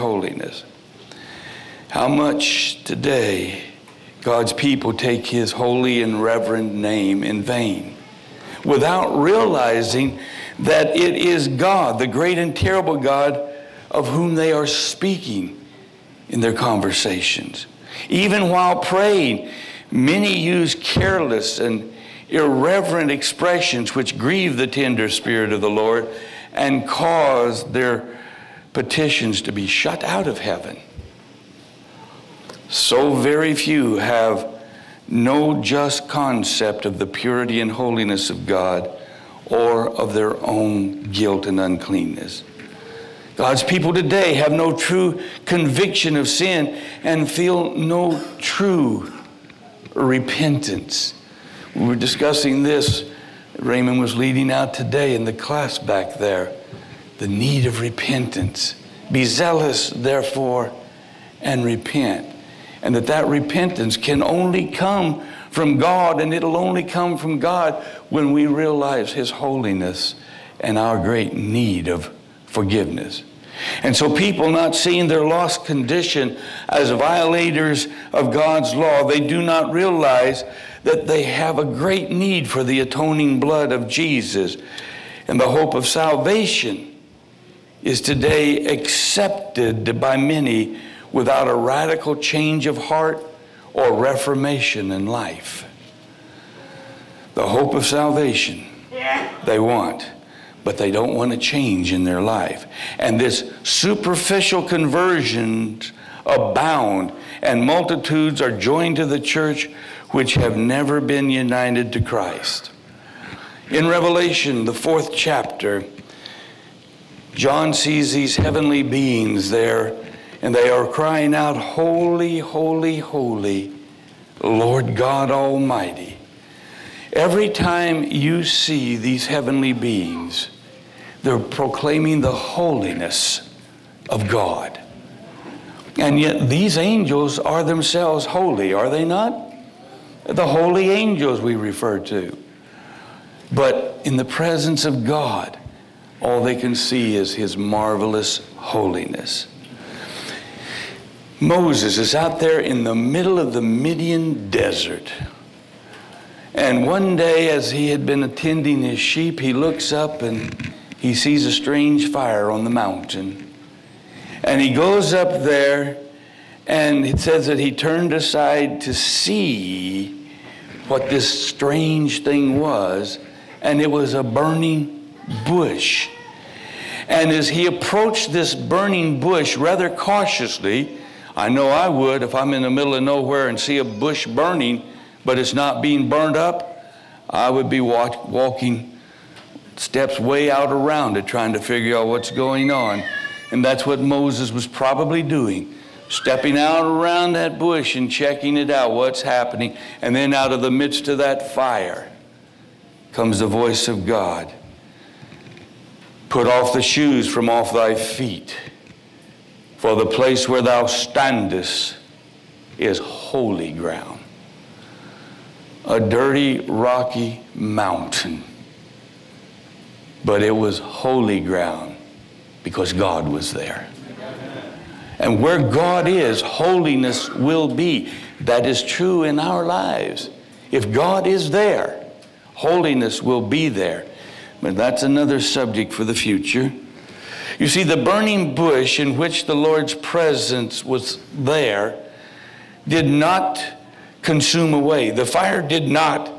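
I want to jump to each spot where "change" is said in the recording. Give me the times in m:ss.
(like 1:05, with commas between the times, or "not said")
1:32, 1:41.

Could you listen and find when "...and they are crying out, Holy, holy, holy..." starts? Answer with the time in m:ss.
2:00.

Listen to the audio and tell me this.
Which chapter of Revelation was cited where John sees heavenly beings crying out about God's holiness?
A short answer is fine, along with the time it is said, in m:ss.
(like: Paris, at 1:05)
fourth chapter, at 1:54.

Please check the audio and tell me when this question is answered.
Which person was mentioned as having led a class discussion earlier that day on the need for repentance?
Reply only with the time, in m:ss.
0:53.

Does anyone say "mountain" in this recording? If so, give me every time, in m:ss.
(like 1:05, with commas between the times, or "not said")
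2:42, 3:37.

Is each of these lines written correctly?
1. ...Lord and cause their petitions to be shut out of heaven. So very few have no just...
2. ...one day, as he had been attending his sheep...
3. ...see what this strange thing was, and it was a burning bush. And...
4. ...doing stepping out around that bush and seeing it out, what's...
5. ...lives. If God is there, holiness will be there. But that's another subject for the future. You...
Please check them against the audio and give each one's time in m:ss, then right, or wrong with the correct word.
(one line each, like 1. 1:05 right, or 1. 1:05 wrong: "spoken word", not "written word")
1. 0:25 right
2. 2:36 right
3. 2:48 right
4. 3:15 wrong: "checking", not "seeing"
5. 3:49 right.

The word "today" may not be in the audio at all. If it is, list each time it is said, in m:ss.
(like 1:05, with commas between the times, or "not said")
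0:02, 0:43, 0:54, 1:28.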